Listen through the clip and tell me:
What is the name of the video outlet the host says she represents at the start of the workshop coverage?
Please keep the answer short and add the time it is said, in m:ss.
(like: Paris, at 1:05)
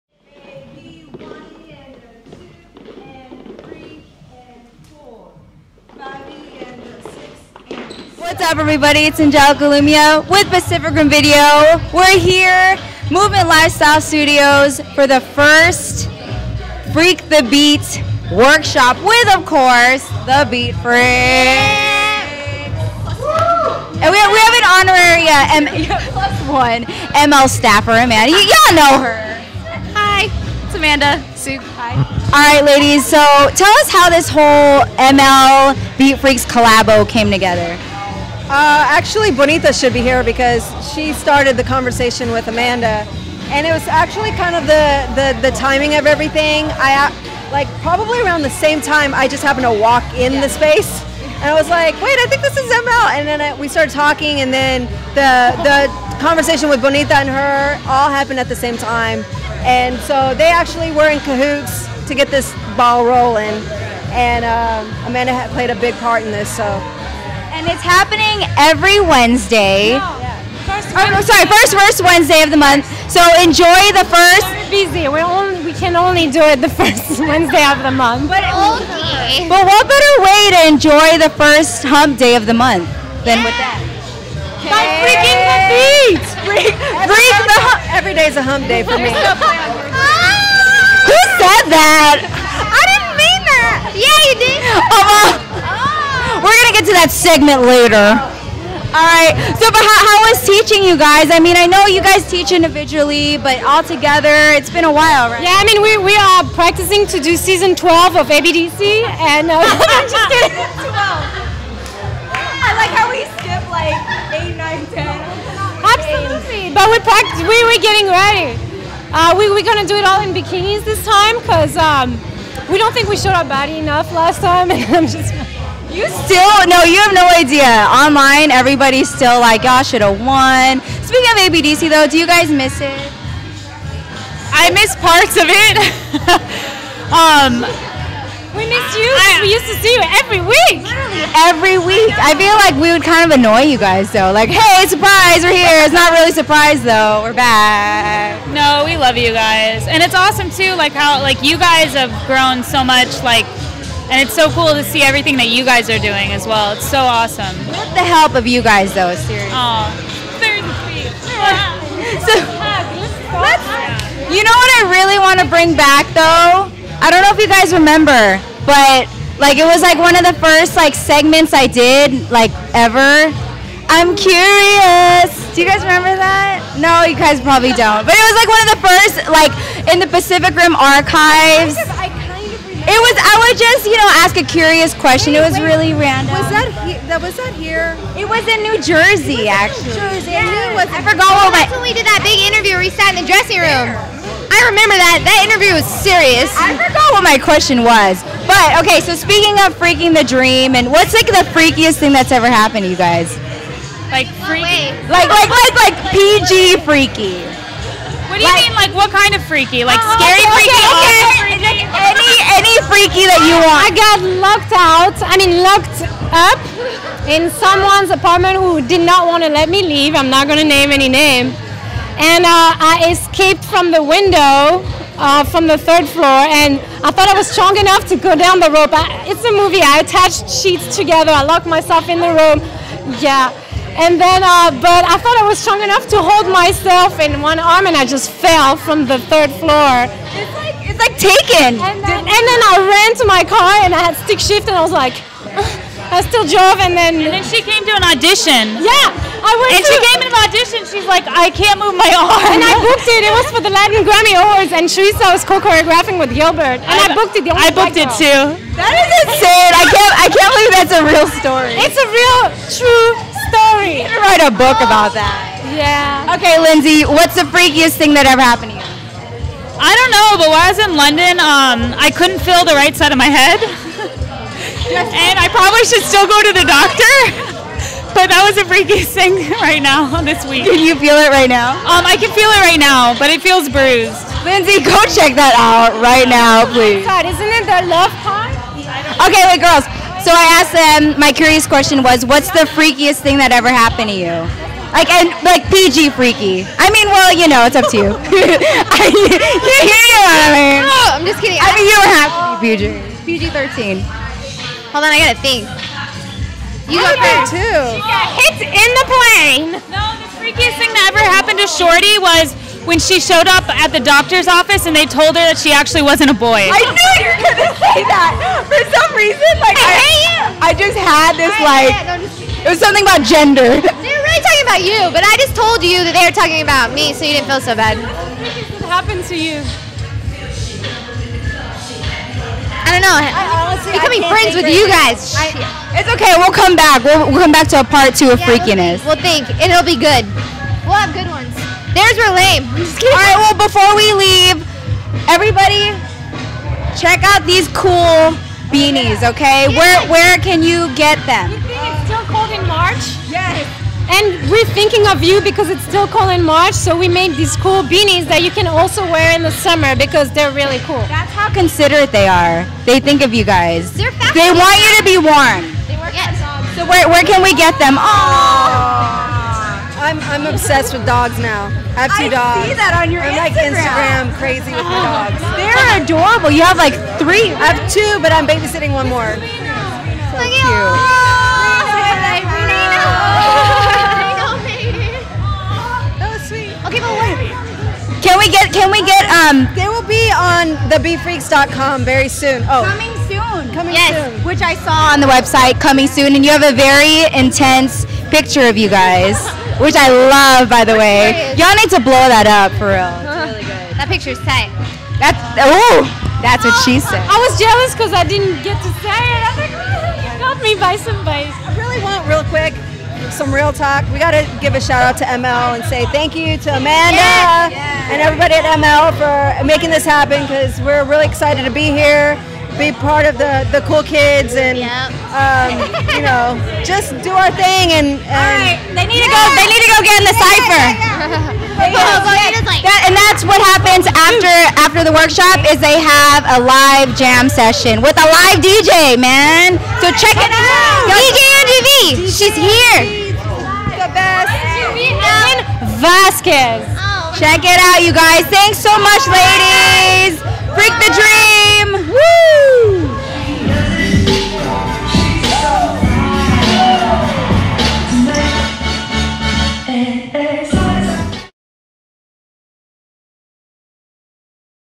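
Pacific Rim Video, at 0:10.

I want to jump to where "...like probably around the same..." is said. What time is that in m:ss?
0:47.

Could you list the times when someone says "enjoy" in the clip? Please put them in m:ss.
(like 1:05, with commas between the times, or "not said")
1:13, 1:20.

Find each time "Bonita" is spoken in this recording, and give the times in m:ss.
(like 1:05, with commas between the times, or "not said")
0:39, 0:56.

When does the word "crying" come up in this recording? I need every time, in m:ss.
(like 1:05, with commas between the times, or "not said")
not said.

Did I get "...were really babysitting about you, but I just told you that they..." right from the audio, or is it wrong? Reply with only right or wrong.
wrong.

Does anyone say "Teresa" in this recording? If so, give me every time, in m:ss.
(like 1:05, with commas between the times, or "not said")
4:14.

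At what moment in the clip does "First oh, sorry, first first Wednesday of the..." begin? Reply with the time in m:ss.
1:10.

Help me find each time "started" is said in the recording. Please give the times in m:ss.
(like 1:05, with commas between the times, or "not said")
0:41, 0:53.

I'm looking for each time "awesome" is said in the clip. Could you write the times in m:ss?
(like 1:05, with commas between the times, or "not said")
2:30, 2:36.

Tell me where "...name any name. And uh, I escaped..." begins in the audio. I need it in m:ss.
3:40.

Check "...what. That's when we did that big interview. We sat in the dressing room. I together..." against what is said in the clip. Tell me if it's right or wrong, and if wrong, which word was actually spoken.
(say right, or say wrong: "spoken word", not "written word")
wrong: "remember", not "together".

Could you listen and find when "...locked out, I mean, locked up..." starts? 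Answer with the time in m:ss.
3:34.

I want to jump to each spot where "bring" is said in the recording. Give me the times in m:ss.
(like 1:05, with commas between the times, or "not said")
2:45.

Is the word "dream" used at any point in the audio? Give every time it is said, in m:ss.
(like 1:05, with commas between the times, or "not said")
3:20, 7:31.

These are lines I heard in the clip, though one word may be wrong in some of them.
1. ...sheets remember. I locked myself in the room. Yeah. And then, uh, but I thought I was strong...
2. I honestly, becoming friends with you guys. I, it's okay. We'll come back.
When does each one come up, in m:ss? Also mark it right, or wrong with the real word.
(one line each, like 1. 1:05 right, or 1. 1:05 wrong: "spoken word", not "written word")
1. 3:50 wrong: "together", not "remember"
2. 5:33 right.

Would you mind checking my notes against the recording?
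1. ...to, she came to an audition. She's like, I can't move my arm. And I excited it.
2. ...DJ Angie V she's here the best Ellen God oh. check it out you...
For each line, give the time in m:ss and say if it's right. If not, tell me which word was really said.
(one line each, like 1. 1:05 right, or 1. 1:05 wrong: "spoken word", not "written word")
1. 4:09 wrong: "booked", not "excited"
2. 7:21 wrong: "Vasquez", not "God".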